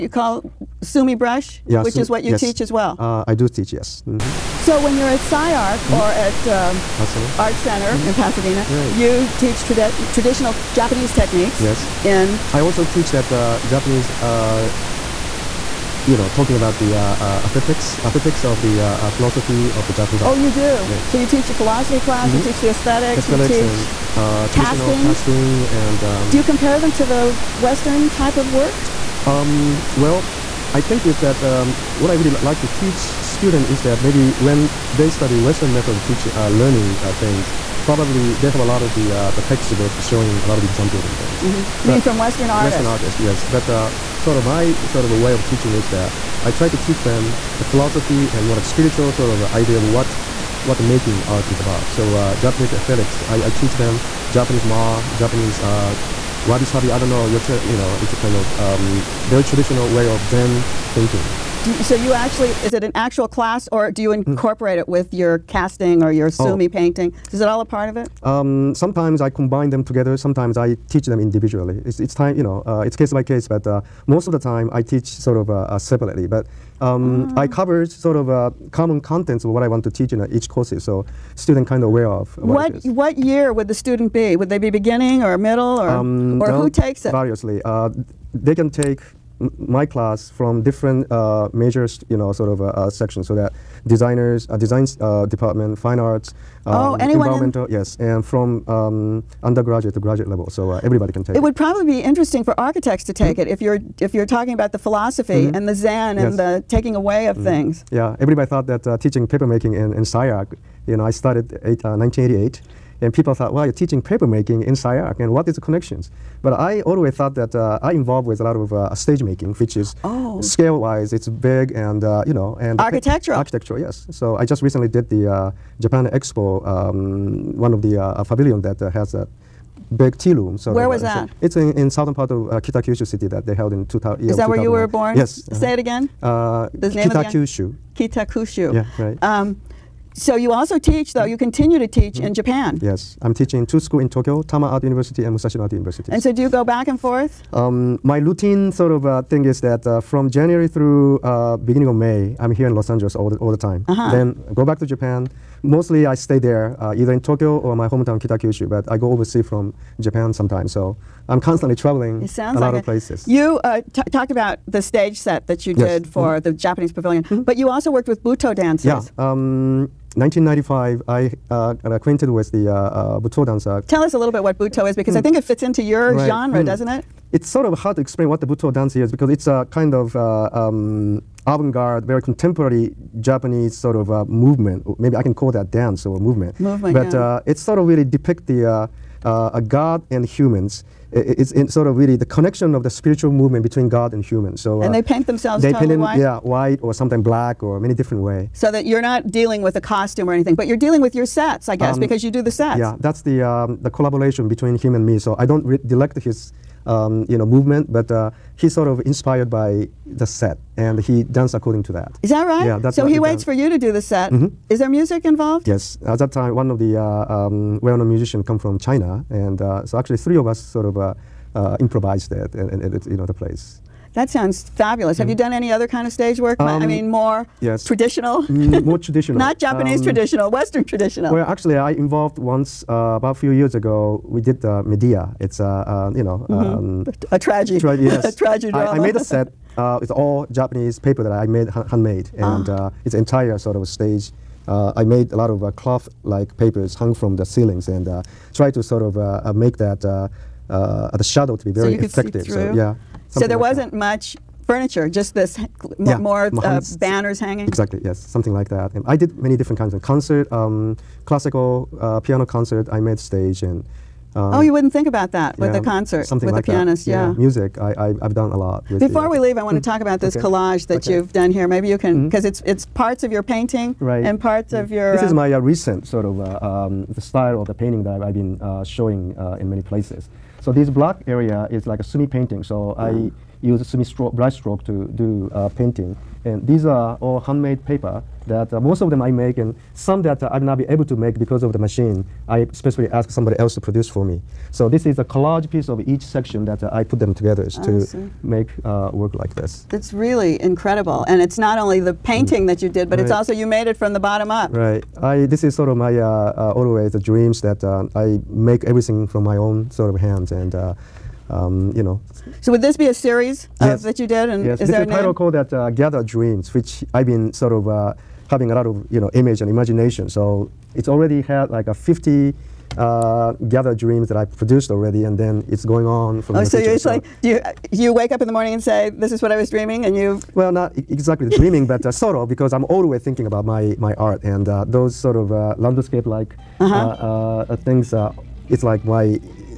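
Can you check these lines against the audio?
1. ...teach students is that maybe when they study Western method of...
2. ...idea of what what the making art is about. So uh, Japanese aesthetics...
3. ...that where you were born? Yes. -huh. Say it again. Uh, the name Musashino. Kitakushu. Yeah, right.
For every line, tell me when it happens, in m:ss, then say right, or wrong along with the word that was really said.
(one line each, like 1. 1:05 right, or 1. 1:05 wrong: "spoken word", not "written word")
1. 0:32 right
2. 0:49 right
3. 2:14 wrong: "Kitakyushu", not "Musashino".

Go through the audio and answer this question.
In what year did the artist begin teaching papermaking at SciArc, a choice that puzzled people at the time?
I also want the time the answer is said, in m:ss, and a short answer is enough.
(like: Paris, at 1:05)
1988, at 1:51.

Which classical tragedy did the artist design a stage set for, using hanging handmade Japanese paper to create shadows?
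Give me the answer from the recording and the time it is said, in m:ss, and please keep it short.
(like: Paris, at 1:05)
Medea, at 3:54.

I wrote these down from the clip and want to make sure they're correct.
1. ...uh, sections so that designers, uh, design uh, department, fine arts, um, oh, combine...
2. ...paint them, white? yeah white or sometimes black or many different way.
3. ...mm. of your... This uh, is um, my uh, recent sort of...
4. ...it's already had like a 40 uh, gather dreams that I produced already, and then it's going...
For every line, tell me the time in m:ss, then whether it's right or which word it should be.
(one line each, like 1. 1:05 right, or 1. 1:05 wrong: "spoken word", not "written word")
1. 1:32 wrong: "anyone", not "combine"
2. 3:15 right
3. 4:34 right
4. 5:20 wrong: "50", not "40".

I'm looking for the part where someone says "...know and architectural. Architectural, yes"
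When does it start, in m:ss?
2:02.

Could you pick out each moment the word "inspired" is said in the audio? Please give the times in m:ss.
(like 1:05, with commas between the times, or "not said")
3:29.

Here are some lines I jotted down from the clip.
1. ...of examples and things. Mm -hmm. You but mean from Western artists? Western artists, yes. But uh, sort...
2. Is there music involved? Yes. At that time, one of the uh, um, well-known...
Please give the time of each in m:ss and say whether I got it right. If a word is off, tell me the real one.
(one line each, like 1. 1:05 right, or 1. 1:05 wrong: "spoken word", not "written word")
1. 0:40 right
2. 3:34 right.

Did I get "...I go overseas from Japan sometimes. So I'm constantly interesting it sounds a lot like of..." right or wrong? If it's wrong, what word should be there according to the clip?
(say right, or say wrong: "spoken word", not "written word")
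wrong: "traveling", not "interesting".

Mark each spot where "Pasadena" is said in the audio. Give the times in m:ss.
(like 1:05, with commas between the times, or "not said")
0:08.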